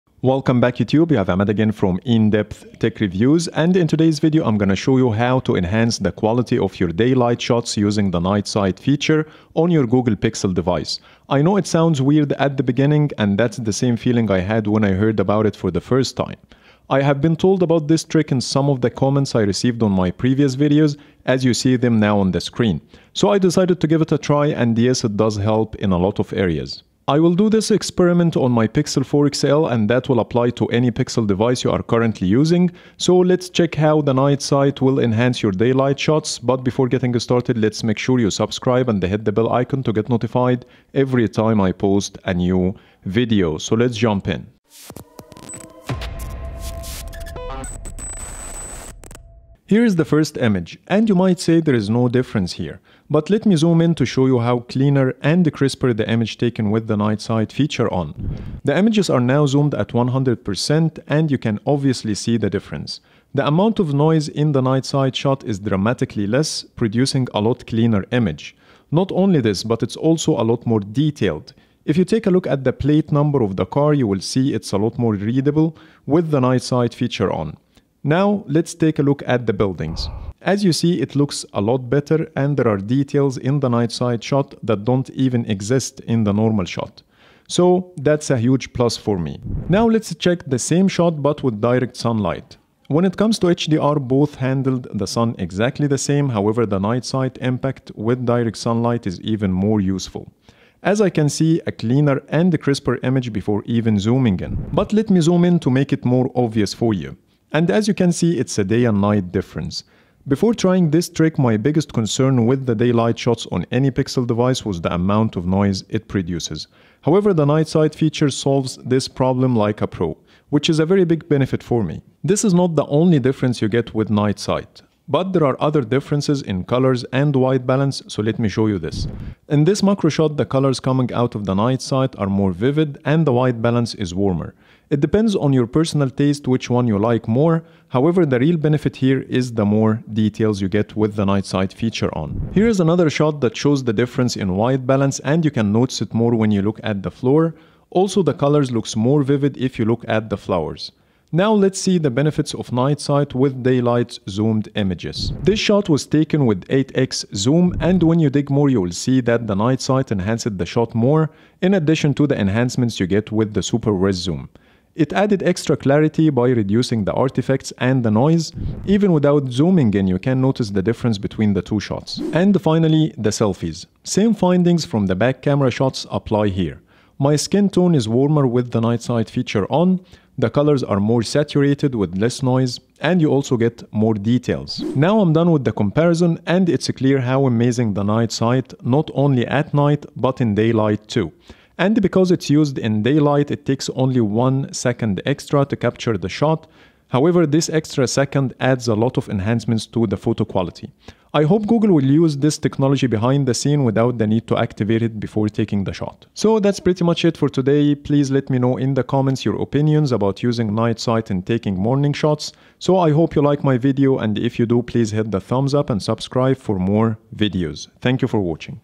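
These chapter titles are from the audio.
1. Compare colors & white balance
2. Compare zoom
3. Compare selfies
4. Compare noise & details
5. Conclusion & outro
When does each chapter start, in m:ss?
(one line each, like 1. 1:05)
1. 2:09
2. 2:36
3. 2:51
4. 0:48
5. 3:05.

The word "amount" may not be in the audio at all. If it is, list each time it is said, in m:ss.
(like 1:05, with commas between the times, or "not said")
1:03, 1:54.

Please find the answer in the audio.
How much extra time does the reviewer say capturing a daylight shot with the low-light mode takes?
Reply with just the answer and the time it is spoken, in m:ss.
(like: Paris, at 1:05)
1 second, at 3:14.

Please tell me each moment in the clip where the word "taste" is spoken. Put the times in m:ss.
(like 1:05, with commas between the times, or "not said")
2:16.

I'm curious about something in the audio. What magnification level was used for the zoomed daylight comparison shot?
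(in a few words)
8x.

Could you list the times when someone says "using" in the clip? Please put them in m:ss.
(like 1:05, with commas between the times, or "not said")
0:07, 0:32, 3:30.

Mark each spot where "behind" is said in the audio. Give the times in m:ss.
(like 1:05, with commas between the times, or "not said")
3:23.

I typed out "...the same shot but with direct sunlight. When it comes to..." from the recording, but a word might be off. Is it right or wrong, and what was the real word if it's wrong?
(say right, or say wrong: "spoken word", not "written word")
right.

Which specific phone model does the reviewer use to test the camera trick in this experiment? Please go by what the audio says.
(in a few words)
Pixel 4 XL.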